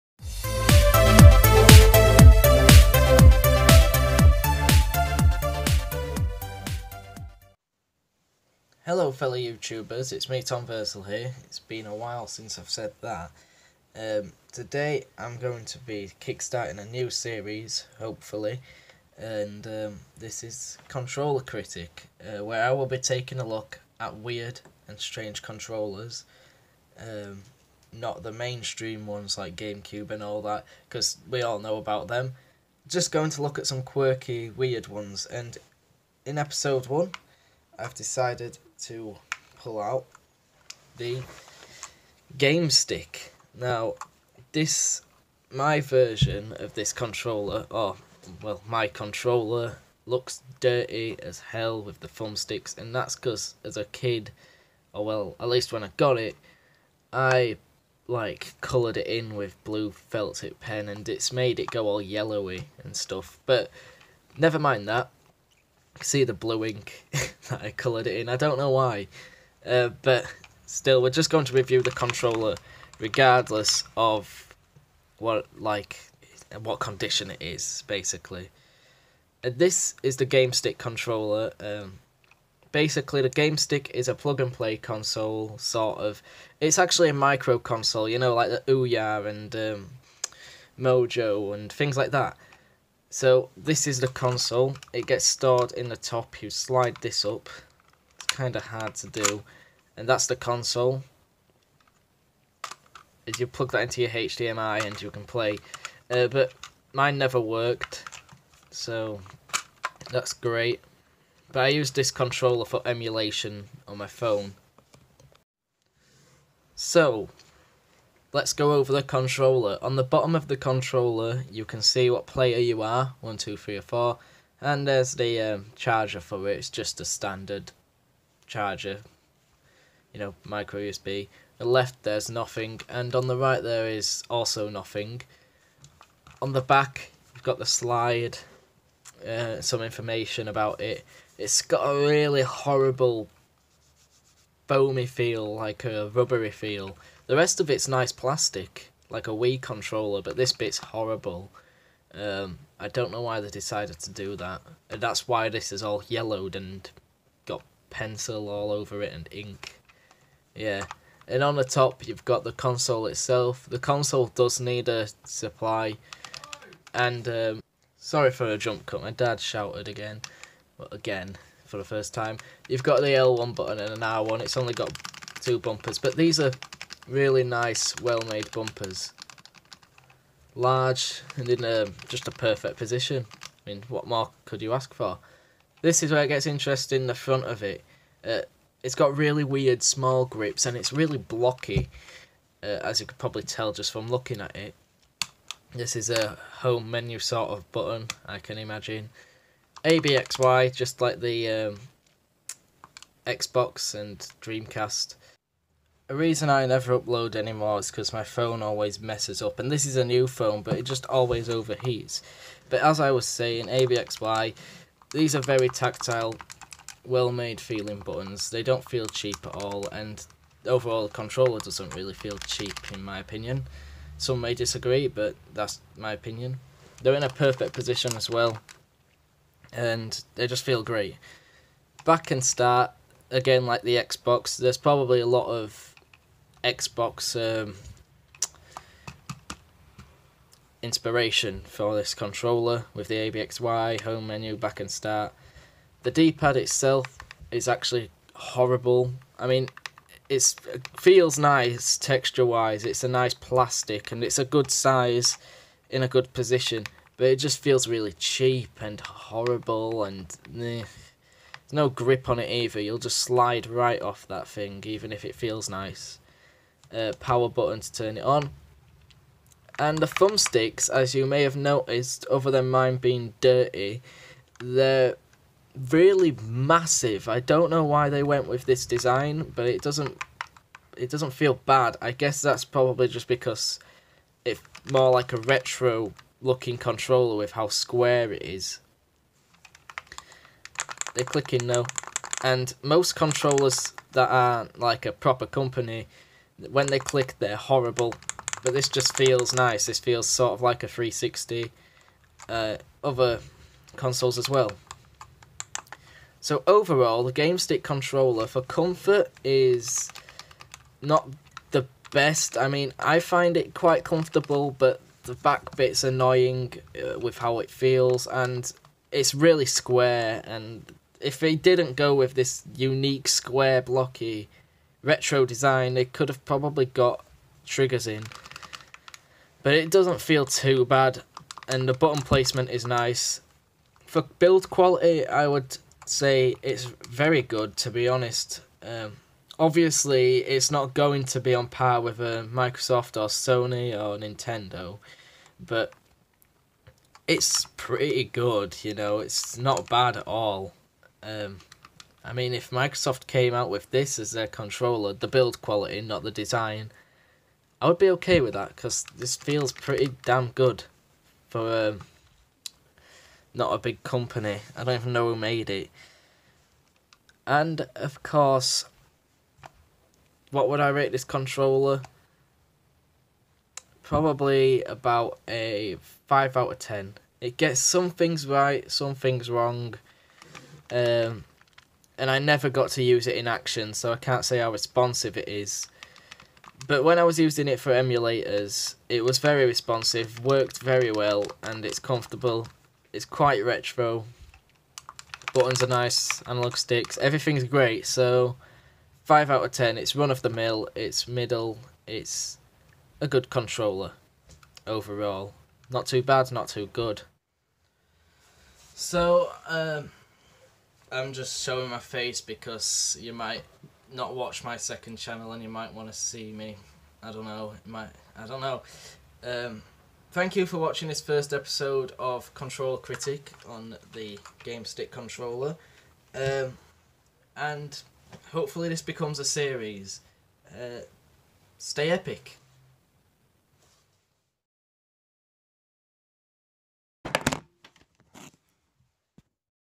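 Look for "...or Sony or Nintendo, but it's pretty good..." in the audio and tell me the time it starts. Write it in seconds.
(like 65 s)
343 s.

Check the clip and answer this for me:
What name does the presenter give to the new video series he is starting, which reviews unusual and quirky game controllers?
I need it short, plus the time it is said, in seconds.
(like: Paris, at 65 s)
Controller Critic, at 20 s.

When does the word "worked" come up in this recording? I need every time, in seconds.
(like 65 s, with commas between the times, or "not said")
107 s, 390 s.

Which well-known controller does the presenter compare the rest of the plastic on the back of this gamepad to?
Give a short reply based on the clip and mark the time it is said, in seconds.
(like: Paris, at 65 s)
Wii controller, at 149 s.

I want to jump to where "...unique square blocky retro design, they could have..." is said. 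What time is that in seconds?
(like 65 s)
322 s.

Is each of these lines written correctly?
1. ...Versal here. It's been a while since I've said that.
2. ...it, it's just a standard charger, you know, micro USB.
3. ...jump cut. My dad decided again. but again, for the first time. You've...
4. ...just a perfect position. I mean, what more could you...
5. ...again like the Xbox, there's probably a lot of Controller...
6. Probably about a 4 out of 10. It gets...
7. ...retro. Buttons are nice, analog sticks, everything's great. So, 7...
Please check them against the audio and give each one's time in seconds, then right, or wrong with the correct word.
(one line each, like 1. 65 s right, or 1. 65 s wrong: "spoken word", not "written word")
1. 10 s right
2. 126 s right
3. 168 s wrong: "shouted", not "decided"
4. 182 s right
5. 233 s wrong: "Xbox", not "Controller"
6. 374 s wrong: "5", not "4"
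7. 393 s wrong: "5", not "7".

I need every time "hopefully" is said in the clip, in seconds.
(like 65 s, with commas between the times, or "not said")
17 s, 428 s.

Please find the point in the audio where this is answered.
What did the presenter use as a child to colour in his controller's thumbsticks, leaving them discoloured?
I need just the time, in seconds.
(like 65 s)
59 s.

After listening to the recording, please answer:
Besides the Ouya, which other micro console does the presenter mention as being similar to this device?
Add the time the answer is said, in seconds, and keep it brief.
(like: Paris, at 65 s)
Mojo, at 90 s.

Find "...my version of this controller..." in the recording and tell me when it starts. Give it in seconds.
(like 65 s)
45 s.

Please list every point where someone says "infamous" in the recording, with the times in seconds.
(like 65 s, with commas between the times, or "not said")
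not said.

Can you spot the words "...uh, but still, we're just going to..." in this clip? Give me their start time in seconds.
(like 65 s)
69 s.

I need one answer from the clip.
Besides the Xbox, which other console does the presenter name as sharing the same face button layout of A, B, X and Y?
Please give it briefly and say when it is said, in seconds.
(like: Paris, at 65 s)
Dreamcast, at 204 s.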